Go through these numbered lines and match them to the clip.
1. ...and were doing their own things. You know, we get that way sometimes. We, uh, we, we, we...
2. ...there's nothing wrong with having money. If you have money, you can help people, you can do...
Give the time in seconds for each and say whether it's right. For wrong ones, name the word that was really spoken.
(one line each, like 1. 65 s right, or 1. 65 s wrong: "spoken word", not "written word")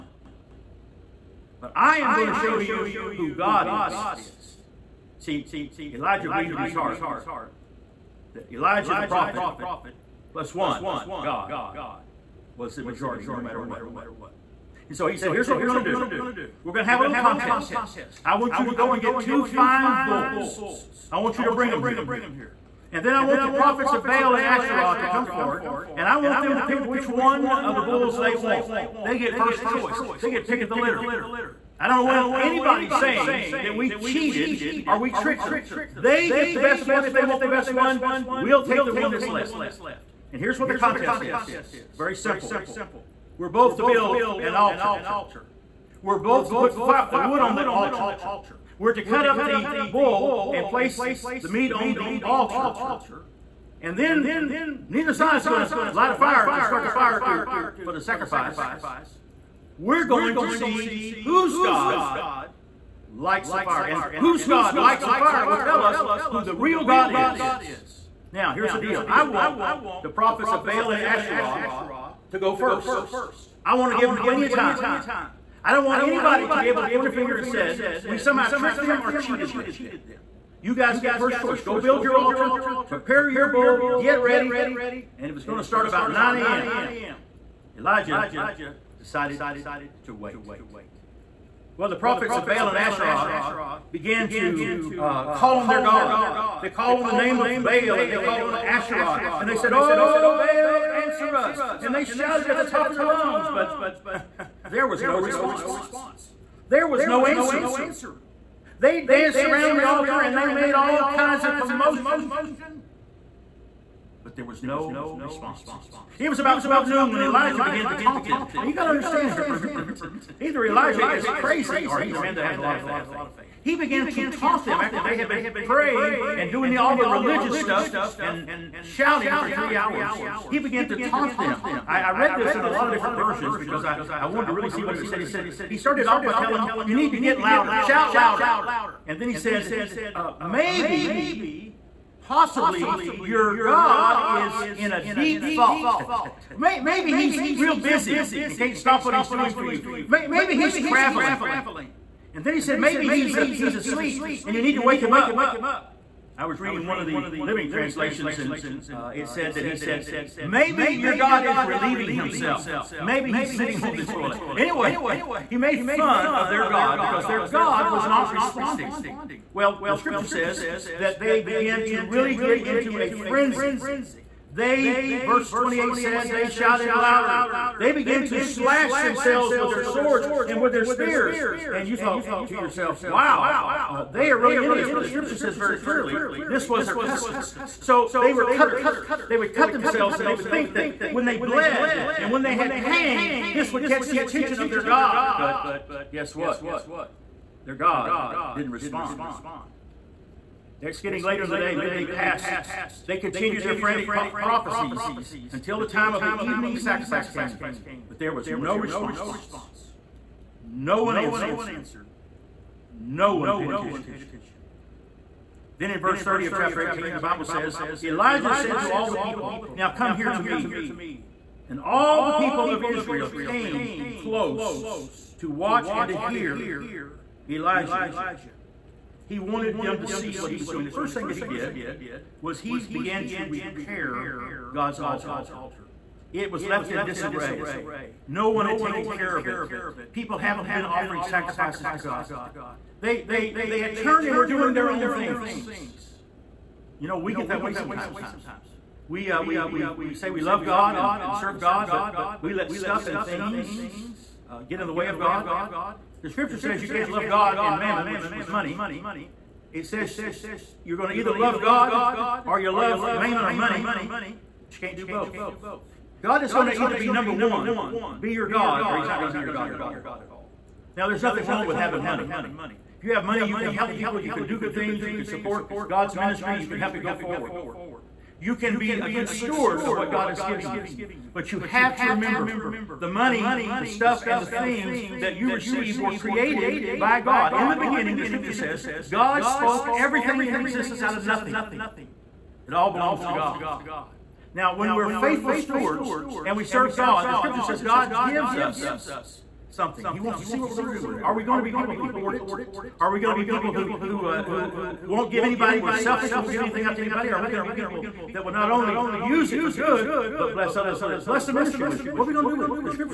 1. 244 s right
2. 271 s right.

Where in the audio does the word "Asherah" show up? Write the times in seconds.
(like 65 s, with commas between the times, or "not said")
24 s, 71 s, 92 s, 98 s.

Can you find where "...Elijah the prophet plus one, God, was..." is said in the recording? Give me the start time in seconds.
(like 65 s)
8 s.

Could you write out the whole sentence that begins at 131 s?
I, I, read this in a lot of different versions because I, I wanted to really see what it said.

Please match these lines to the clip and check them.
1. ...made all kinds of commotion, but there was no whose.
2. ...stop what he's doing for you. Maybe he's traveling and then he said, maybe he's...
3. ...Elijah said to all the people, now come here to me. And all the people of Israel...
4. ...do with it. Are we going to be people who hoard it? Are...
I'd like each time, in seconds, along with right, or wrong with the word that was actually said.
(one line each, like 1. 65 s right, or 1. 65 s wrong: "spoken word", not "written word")
1. 110 s wrong: "response", not "whose"
2. 148 s right
3. 218 s right
4. 300 s right.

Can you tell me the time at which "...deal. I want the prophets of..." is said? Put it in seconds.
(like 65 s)
68 s.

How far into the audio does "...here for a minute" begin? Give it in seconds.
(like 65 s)
119 s.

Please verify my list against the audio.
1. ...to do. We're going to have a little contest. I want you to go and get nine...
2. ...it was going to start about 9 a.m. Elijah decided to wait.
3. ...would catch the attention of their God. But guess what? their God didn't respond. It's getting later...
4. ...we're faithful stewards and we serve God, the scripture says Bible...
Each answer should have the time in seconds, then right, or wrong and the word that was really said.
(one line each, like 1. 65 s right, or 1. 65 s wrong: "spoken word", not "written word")
1. 15 s wrong: "two", not "nine"
2. 85 s right
3. 193 s right
4. 294 s wrong: "God", not "Bible".